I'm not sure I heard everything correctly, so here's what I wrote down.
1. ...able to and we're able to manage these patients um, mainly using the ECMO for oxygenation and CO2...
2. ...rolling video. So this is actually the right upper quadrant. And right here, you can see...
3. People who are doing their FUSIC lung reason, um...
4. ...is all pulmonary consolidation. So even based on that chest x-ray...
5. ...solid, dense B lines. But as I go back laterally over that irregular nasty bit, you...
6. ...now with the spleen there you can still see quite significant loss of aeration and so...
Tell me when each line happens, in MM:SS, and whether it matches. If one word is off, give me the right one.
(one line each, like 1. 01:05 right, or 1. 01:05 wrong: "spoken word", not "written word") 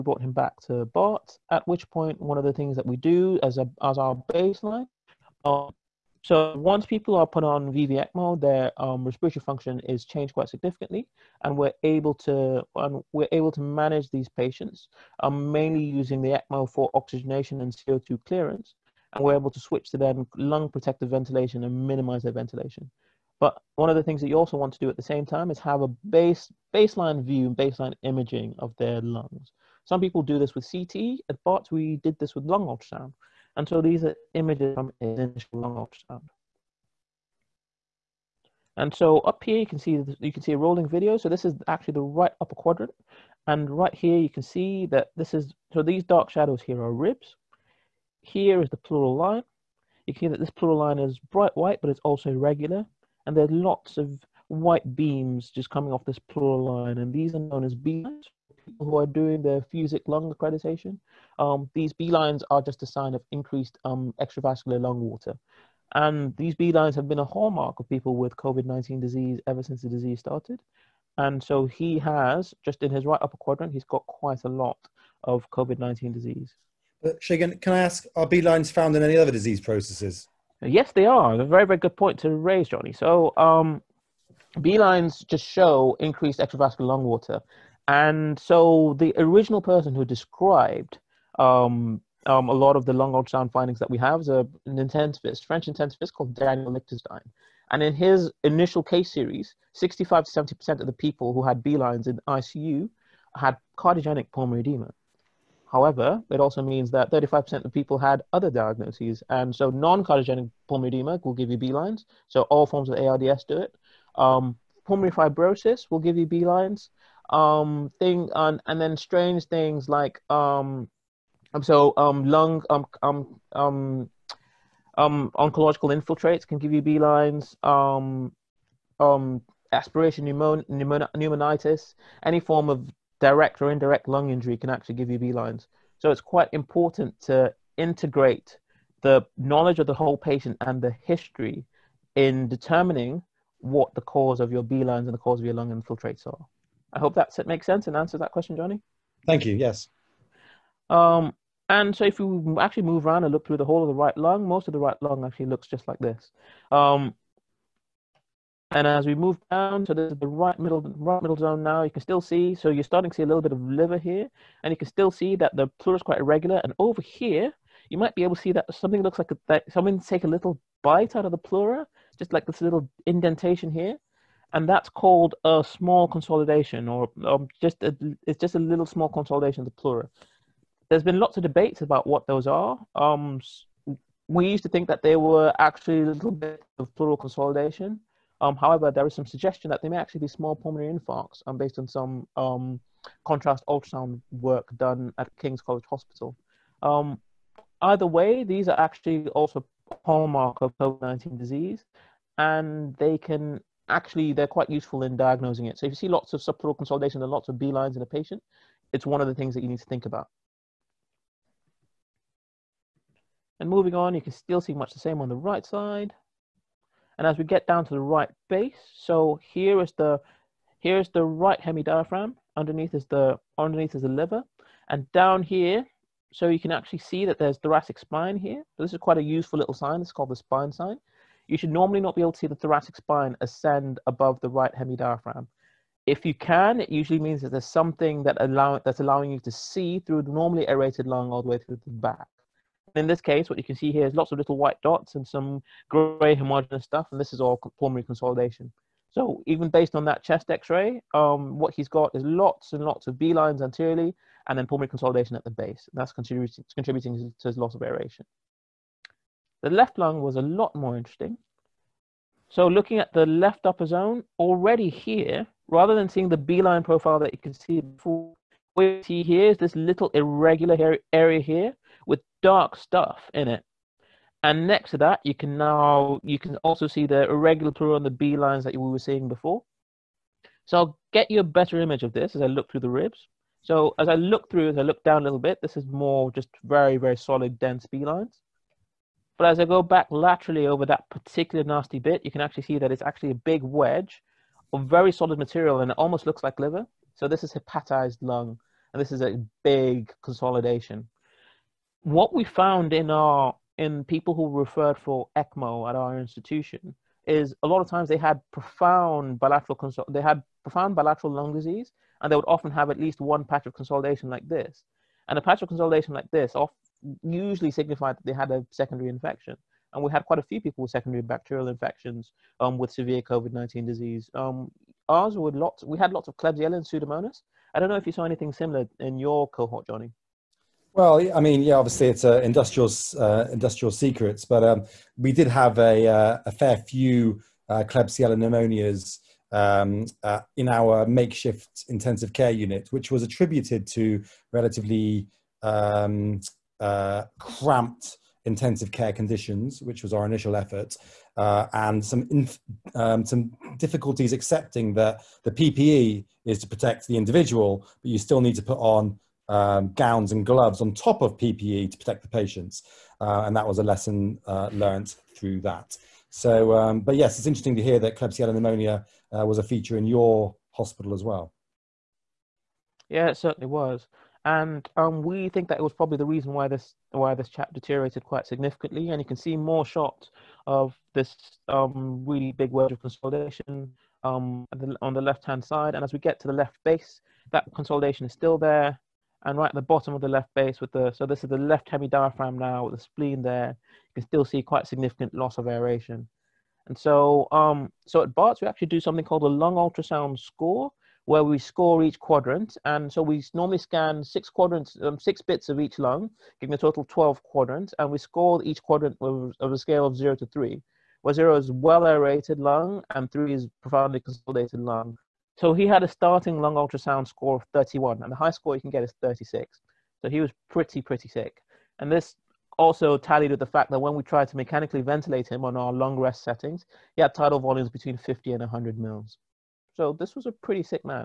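1. 00:11 right
2. 00:40 right
3. 00:58 wrong: "accreditation", not "reason"
4. 04:07 right
5. 04:47 wrong: "particular", not "irregular"
6. 06:32 right.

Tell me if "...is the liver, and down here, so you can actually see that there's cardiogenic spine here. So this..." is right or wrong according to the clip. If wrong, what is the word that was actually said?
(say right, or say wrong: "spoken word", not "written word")
wrong: "thoracic", not "cardiogenic".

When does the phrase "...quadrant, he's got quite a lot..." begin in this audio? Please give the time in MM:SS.
01:13.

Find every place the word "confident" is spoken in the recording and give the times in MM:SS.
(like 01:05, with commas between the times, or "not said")
not said.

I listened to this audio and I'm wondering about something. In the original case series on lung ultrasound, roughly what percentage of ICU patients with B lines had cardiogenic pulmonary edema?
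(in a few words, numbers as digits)
65 to 70%.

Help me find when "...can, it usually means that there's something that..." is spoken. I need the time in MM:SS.
03:56.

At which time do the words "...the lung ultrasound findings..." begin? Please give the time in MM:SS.
01:32.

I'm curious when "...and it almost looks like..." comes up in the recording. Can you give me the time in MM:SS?
04:55.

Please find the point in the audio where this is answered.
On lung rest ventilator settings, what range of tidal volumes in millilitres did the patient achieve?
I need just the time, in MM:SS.
07:07.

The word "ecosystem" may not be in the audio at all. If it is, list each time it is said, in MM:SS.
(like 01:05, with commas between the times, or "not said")
not said.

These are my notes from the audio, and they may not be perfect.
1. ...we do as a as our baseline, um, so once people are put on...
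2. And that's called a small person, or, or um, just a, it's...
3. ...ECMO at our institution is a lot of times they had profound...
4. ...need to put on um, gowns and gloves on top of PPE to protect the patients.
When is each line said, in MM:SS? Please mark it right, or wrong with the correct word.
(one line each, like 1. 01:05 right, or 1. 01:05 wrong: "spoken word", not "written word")
1. 00:02 right
2. 02:54 wrong: "consolidation", not "person"
3. 05:05 right
4. 05:58 right.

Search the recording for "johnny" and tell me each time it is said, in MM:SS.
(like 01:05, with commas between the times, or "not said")
01:22, 02:28, 05:29.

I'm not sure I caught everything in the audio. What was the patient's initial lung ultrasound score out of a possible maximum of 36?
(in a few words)
31.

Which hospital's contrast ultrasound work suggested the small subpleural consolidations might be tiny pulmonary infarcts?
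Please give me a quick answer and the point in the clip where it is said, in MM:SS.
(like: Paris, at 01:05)
King's College Hospital, at 03:15.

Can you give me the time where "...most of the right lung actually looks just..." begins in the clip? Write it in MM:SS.
02:34.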